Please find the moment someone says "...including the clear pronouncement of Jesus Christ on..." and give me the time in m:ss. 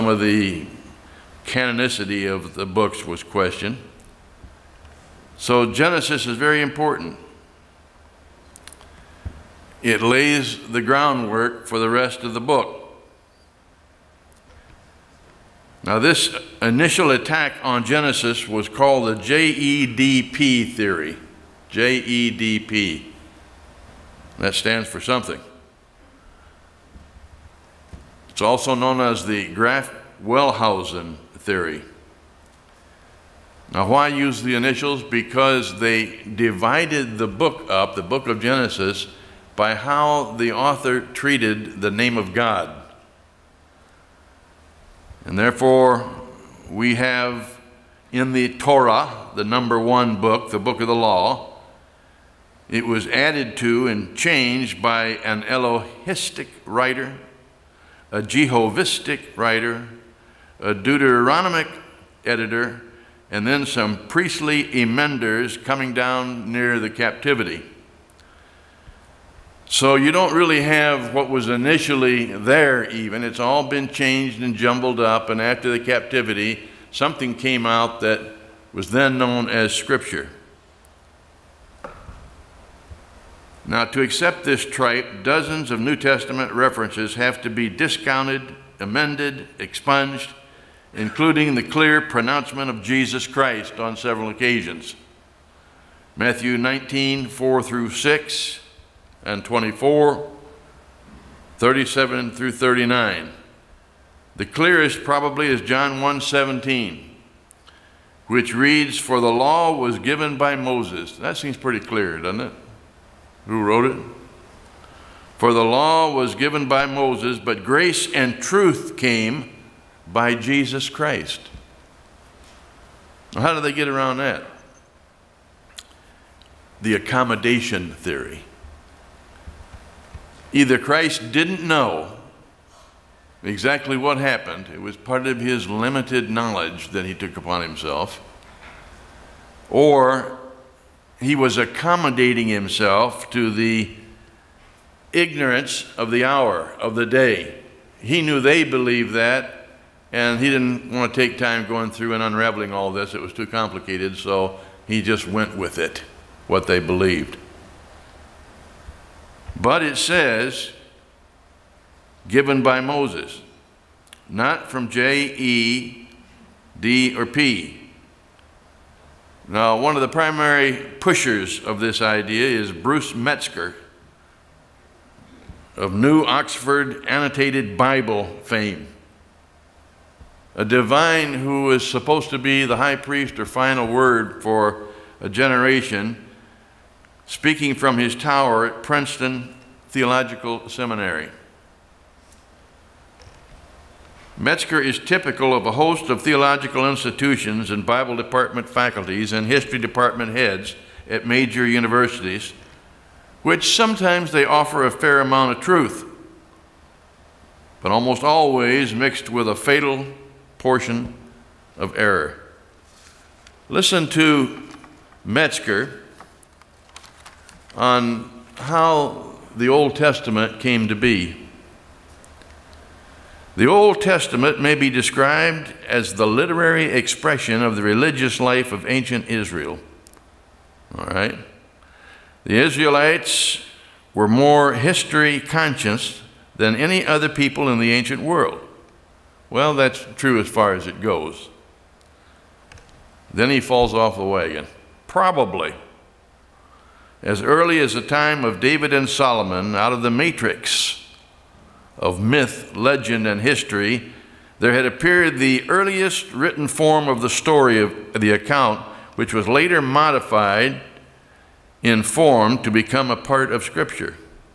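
1:30.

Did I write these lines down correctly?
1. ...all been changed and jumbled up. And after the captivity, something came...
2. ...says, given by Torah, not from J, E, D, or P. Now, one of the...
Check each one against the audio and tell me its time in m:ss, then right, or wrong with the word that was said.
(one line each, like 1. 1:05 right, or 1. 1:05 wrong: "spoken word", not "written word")
1. 1:13 right
2. 2:39 wrong: "Moses", not "Torah".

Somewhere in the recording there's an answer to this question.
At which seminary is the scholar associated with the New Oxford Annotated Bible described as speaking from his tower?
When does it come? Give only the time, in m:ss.
3:08.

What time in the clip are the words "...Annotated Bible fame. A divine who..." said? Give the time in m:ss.
2:57.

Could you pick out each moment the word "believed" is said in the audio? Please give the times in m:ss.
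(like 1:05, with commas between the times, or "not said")
2:28, 2:36.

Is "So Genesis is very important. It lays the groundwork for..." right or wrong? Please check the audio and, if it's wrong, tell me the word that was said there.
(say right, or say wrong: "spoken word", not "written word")
right.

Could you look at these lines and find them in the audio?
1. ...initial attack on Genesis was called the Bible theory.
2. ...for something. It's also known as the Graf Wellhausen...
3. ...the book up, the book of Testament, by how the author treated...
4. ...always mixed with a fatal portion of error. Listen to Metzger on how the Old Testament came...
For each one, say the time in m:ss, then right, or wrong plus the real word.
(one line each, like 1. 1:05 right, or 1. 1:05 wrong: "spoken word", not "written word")
1. 0:16 wrong: "JEDP", not "Bible"
2. 0:24 right
3. 0:37 wrong: "Genesis", not "Testament"
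4. 3:28 right.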